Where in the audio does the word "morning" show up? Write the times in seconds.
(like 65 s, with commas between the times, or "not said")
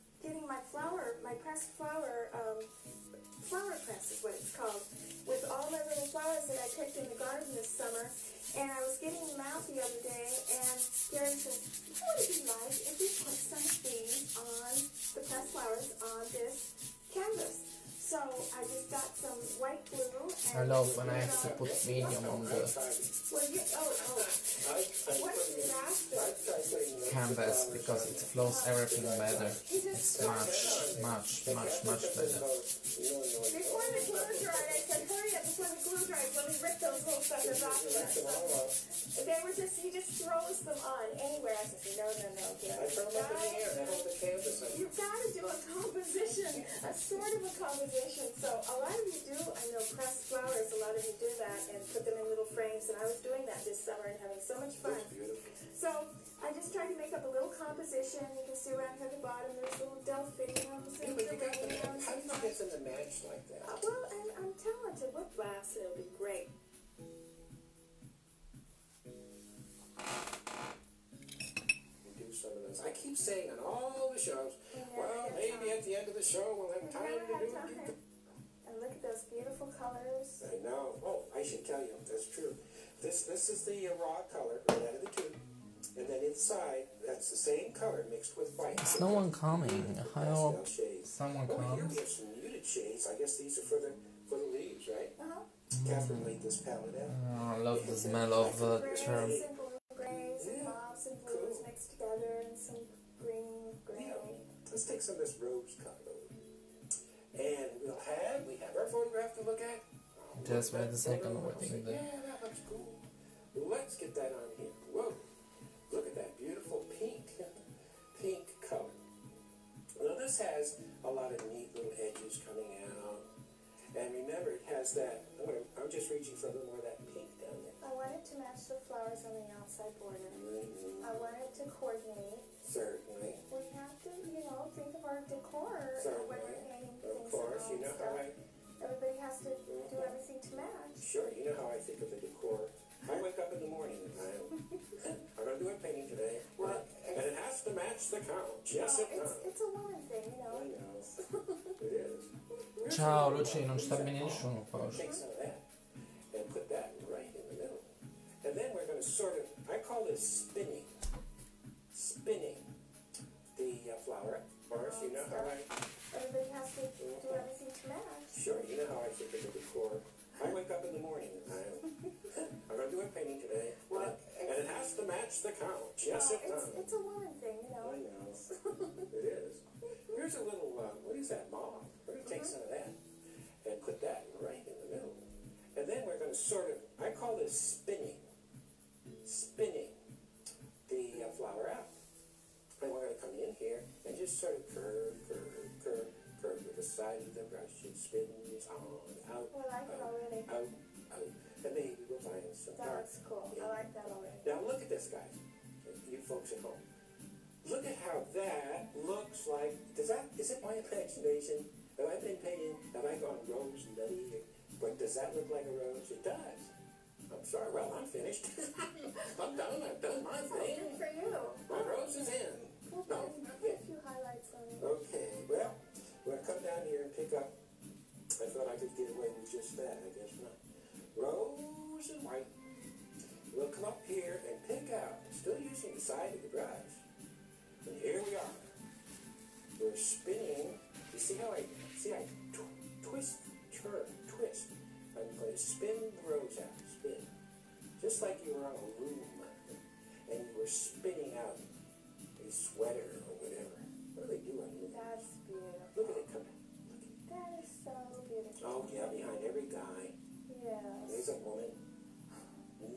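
143 s, 171 s.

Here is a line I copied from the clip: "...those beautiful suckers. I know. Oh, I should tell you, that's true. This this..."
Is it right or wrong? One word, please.
wrong.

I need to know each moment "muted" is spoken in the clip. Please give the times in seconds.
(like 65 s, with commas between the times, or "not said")
92 s.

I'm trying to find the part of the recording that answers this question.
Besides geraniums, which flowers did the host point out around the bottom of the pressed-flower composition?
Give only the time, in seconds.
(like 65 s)
60 s.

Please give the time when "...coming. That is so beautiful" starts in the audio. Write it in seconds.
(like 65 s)
256 s.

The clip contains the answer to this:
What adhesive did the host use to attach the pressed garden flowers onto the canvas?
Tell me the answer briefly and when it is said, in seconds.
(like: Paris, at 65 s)
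White glue, at 19 s.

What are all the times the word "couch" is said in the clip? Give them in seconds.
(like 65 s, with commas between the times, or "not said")
148 s, 175 s.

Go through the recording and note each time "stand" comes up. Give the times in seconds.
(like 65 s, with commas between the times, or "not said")
not said.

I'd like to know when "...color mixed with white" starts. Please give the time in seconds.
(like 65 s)
87 s.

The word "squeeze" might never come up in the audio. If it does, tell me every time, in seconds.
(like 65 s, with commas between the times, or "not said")
not said.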